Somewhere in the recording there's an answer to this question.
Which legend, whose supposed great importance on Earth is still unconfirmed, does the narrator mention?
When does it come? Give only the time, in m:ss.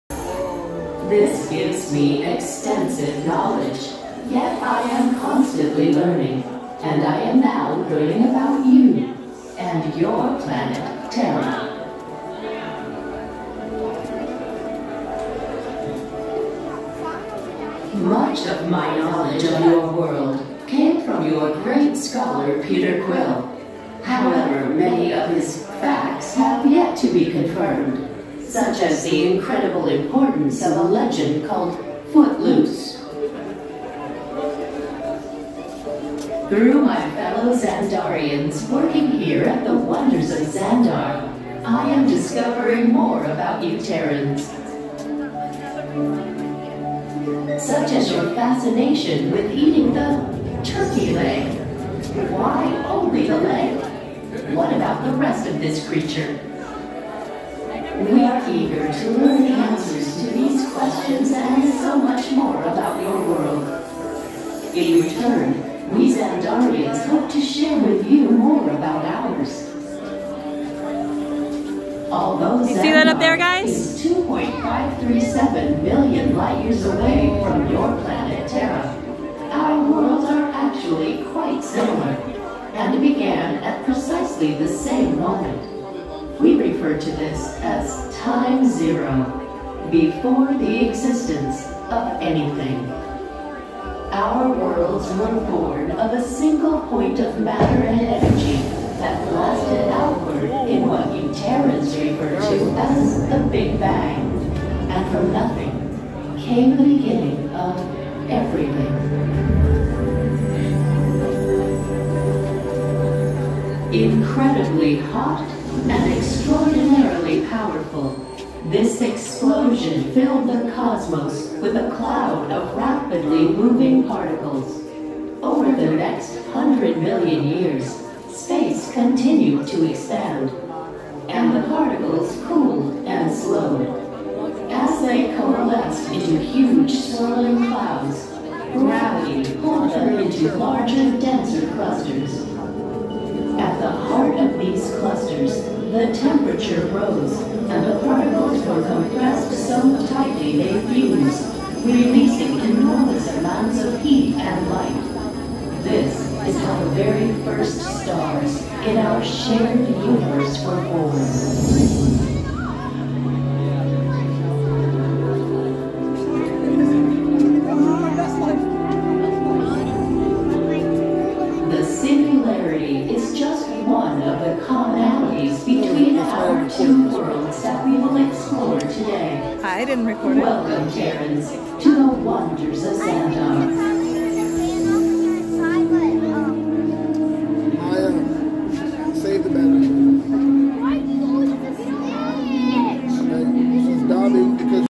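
0:32.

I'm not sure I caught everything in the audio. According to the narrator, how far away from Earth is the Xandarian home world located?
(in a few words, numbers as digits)
2.537 million light years.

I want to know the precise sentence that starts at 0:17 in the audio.
Much of my knowledge of your world came from your great scholar Peter Quill.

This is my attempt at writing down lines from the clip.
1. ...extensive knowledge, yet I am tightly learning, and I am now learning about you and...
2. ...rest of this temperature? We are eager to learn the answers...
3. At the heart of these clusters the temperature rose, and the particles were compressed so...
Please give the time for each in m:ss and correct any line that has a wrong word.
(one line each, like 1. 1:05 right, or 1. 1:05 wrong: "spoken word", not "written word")
1. 0:02 wrong: "constantly", not "tightly"
2. 0:55 wrong: "creature", not "temperature"
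3. 2:23 right.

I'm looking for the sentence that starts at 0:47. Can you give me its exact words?
Such as your fascination with eating the turkey leg.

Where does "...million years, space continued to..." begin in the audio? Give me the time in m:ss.
2:06.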